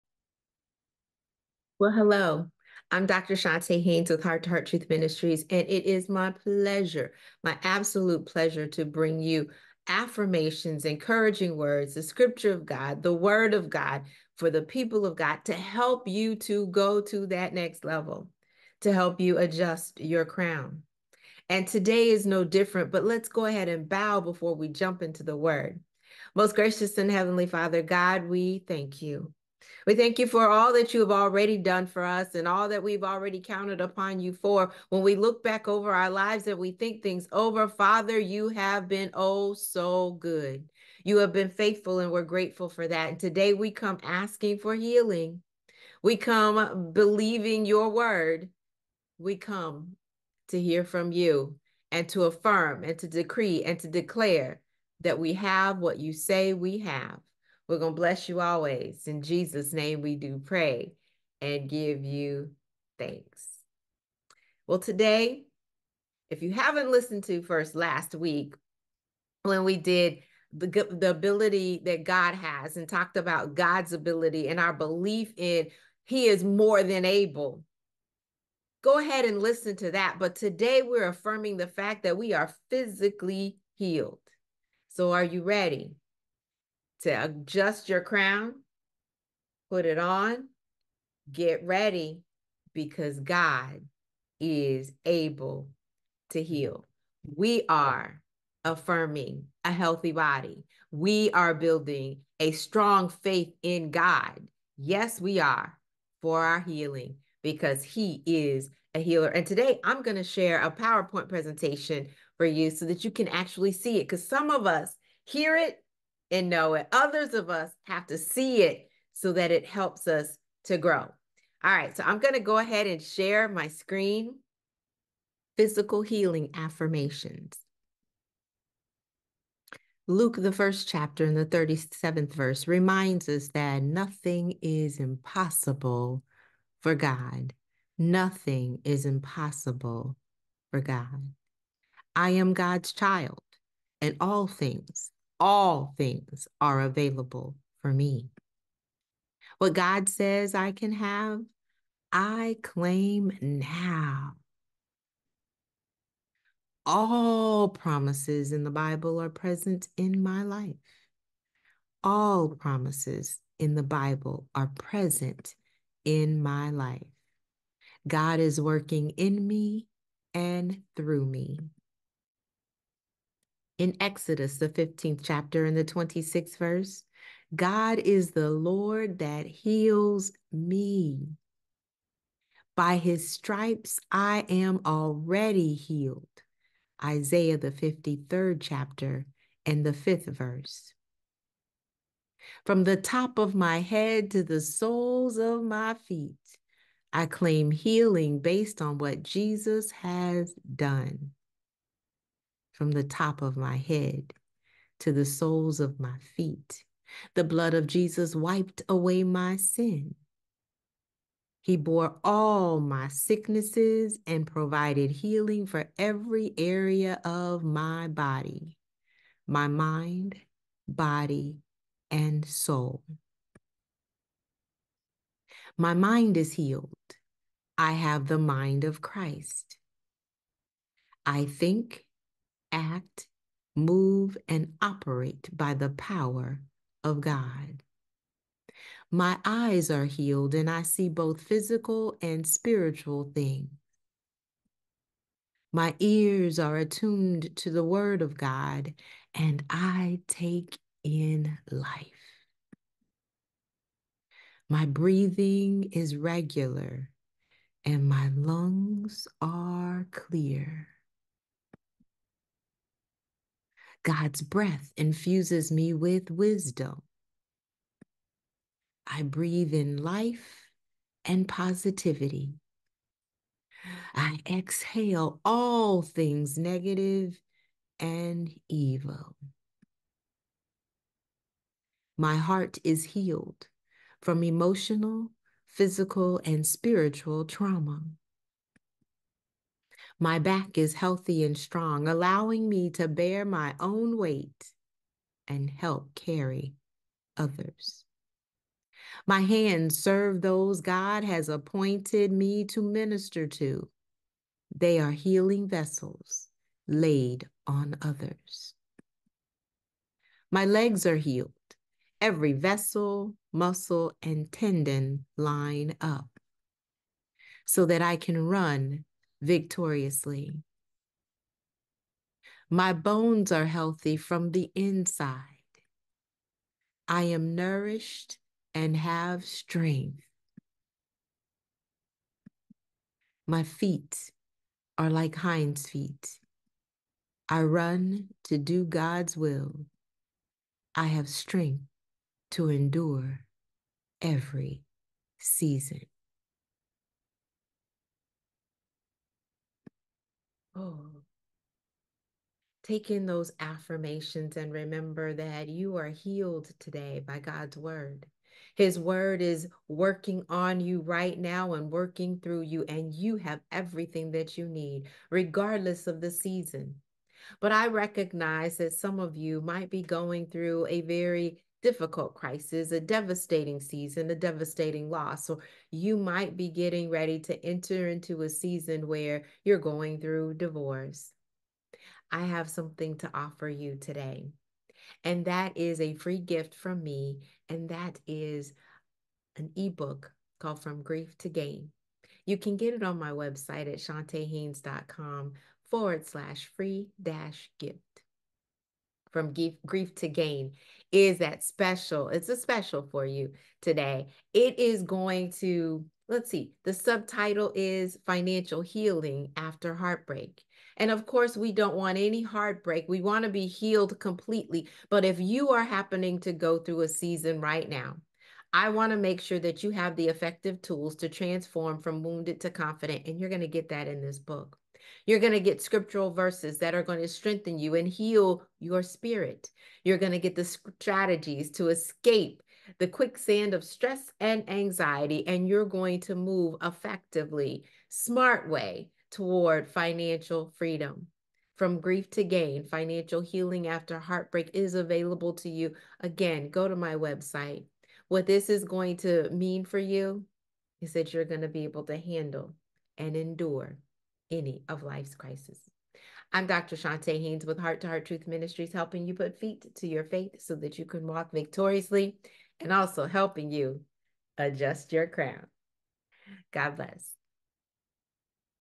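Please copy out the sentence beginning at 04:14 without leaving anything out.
My breathing is regular and my lungs are clear.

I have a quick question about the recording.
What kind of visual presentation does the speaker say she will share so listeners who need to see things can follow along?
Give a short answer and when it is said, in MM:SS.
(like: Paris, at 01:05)
PowerPoint presentation, at 01:50.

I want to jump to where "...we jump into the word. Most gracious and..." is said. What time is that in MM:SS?
00:24.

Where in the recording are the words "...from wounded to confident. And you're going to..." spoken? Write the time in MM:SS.
07:02.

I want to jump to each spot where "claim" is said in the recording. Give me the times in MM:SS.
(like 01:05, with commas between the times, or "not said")
02:32, 03:17.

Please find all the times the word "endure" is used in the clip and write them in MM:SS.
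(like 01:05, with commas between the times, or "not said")
05:42, 07:33.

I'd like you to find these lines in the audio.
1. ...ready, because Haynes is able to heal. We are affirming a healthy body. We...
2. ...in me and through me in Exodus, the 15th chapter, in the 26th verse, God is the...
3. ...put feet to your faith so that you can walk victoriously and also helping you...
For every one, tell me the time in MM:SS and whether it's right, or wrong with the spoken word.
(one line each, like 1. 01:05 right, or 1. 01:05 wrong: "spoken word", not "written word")
1. 01:31 wrong: "God", not "Haynes"
2. 02:49 right
3. 07:39 right.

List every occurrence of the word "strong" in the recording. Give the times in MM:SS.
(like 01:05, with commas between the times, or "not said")
01:42, 04:51.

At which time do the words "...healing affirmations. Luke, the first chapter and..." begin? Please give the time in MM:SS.
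02:06.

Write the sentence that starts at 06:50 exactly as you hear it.
And of course, we don't want any heartbreak.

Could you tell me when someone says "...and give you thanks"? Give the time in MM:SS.
01:01.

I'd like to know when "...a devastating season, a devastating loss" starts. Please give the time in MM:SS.
06:12.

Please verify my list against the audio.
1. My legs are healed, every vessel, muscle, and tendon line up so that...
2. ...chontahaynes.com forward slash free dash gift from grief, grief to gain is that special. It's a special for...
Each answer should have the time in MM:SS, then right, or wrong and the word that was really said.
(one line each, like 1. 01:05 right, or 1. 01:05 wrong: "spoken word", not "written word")
1. 05:10 right
2. 06:33 right.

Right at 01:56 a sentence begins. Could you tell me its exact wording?
Others of us have to see it so that it helps us to grow.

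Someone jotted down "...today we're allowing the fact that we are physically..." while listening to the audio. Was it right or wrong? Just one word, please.
wrong.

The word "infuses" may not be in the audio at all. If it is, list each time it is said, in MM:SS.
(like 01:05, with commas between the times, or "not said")
04:24.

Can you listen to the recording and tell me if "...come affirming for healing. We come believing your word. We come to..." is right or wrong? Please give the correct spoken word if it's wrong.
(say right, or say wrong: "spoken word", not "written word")
wrong: "asking", not "affirming".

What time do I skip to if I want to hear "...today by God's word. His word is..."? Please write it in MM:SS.
05:56.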